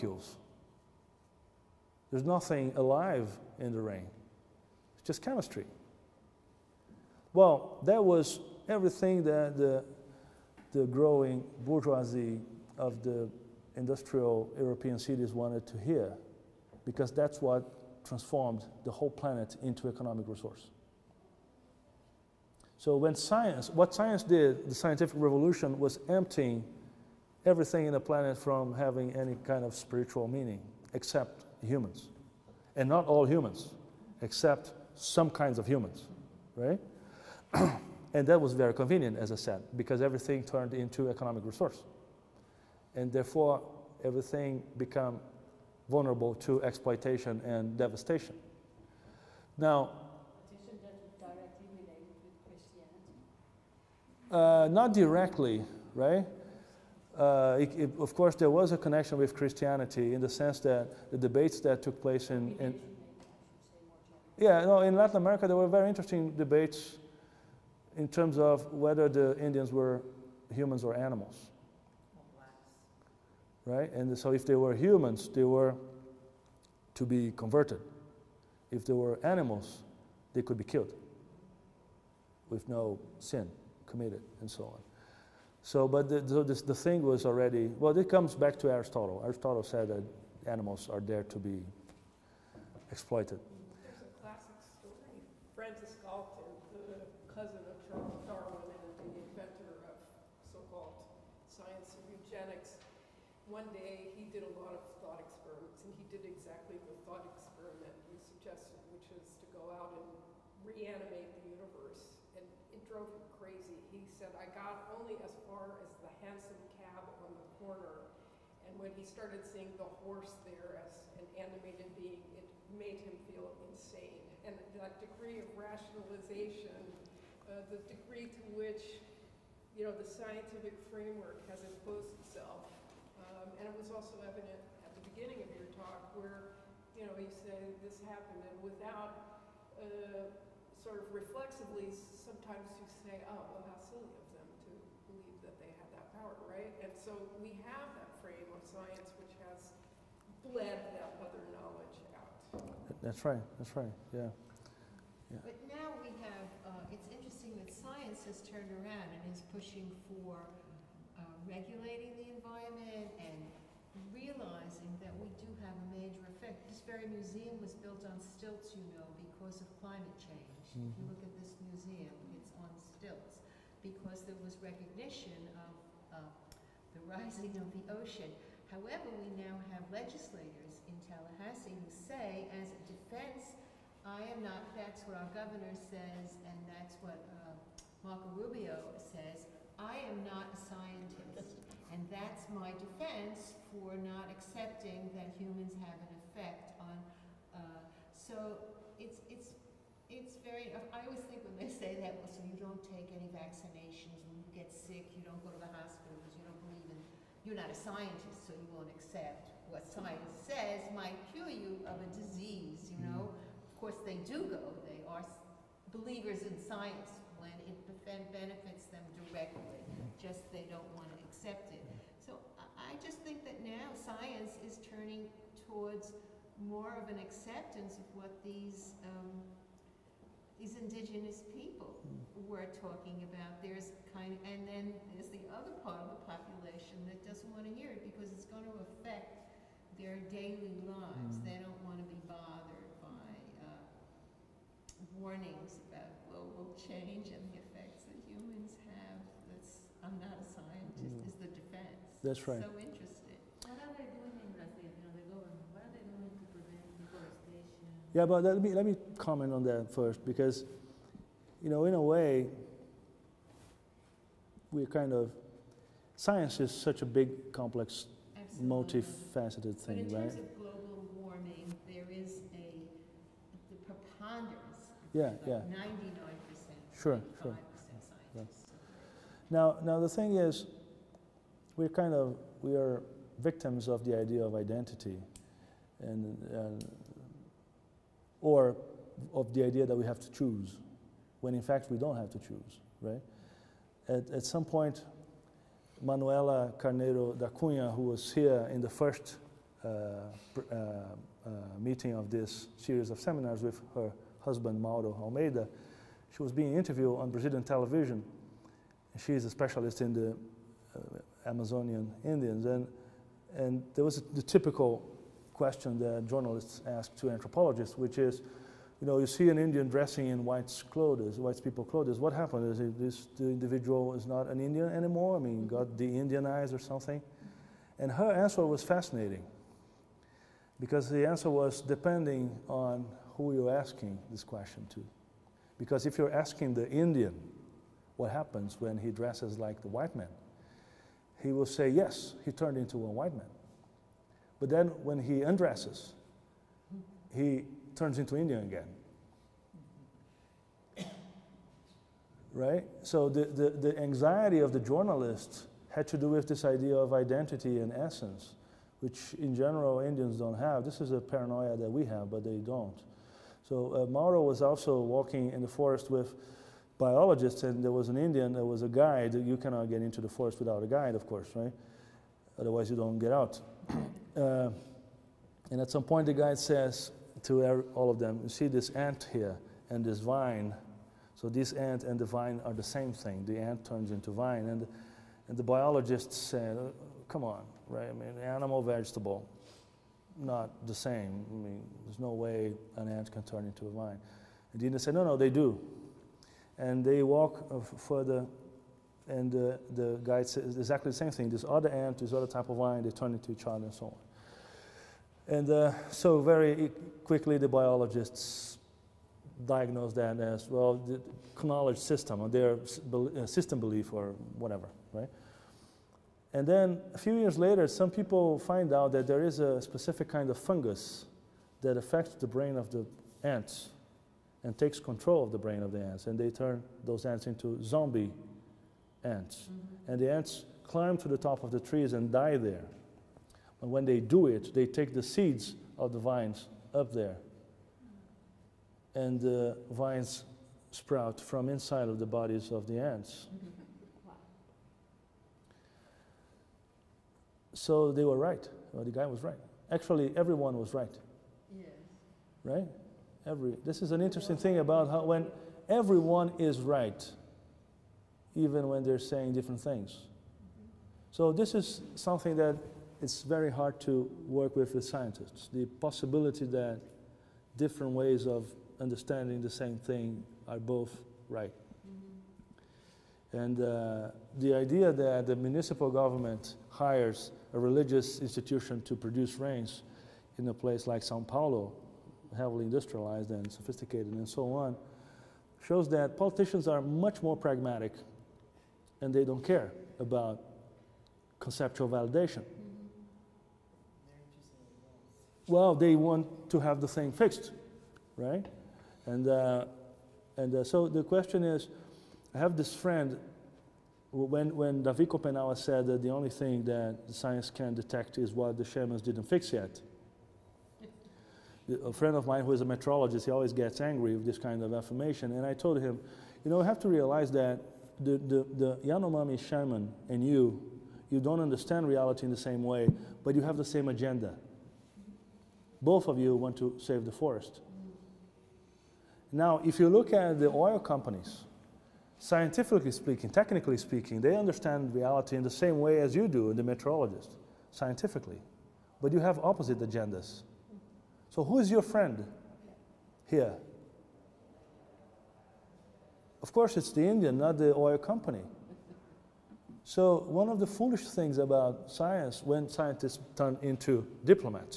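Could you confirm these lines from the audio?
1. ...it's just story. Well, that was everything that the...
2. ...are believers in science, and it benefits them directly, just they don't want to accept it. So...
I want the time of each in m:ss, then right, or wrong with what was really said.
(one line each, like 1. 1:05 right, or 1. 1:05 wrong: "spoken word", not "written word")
1. 0:04 wrong: "chemistry", not "story"
2. 3:35 right.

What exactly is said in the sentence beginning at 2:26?
And so we have that frame of science which has bled that other knowledge out.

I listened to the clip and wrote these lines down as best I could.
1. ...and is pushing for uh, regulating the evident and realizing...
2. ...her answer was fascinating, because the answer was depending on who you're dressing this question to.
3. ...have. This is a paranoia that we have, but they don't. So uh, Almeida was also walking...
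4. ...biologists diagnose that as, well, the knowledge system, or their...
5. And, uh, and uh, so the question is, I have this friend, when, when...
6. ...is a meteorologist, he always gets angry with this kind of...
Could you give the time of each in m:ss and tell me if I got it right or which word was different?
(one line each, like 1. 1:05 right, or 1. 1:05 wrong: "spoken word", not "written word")
1. 2:39 wrong: "environment", not "evident"
2. 5:28 wrong: "asking", not "dressing"
3. 6:00 wrong: "Mauro", not "Almeida"
4. 6:47 right
5. 8:19 right
6. 8:32 right.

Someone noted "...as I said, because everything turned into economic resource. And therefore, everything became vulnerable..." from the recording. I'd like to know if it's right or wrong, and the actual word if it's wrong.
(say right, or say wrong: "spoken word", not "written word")
right.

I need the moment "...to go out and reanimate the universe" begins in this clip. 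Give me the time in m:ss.
1:49.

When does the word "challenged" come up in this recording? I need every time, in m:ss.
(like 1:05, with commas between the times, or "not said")
not said.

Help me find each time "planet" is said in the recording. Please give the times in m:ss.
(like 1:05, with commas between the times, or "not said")
0:19, 0:28.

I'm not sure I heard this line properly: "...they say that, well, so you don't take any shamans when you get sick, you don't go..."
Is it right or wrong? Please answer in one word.
wrong.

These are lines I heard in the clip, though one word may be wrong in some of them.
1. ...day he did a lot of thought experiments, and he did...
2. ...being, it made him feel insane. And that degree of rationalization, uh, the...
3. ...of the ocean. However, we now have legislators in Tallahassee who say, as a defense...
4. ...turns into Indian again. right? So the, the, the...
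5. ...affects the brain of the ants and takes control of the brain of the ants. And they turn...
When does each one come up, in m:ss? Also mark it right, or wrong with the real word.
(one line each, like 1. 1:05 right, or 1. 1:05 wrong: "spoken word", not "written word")
1. 1:43 right
2. 2:02 right
3. 2:57 right
4. 5:47 right
5. 7:01 right.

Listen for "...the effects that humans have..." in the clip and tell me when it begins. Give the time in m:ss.
4:07.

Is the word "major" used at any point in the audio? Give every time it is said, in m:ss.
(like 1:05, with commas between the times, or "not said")
2:45.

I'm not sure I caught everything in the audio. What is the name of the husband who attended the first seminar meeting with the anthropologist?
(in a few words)
Mauro Almeida.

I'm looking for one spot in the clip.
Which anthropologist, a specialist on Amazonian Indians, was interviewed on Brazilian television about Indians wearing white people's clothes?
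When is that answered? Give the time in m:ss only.
4:56.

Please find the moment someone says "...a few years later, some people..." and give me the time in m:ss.
6:57.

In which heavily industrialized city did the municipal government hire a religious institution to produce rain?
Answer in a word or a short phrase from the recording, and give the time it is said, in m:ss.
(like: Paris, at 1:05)
Sao Paulo, at 8:01.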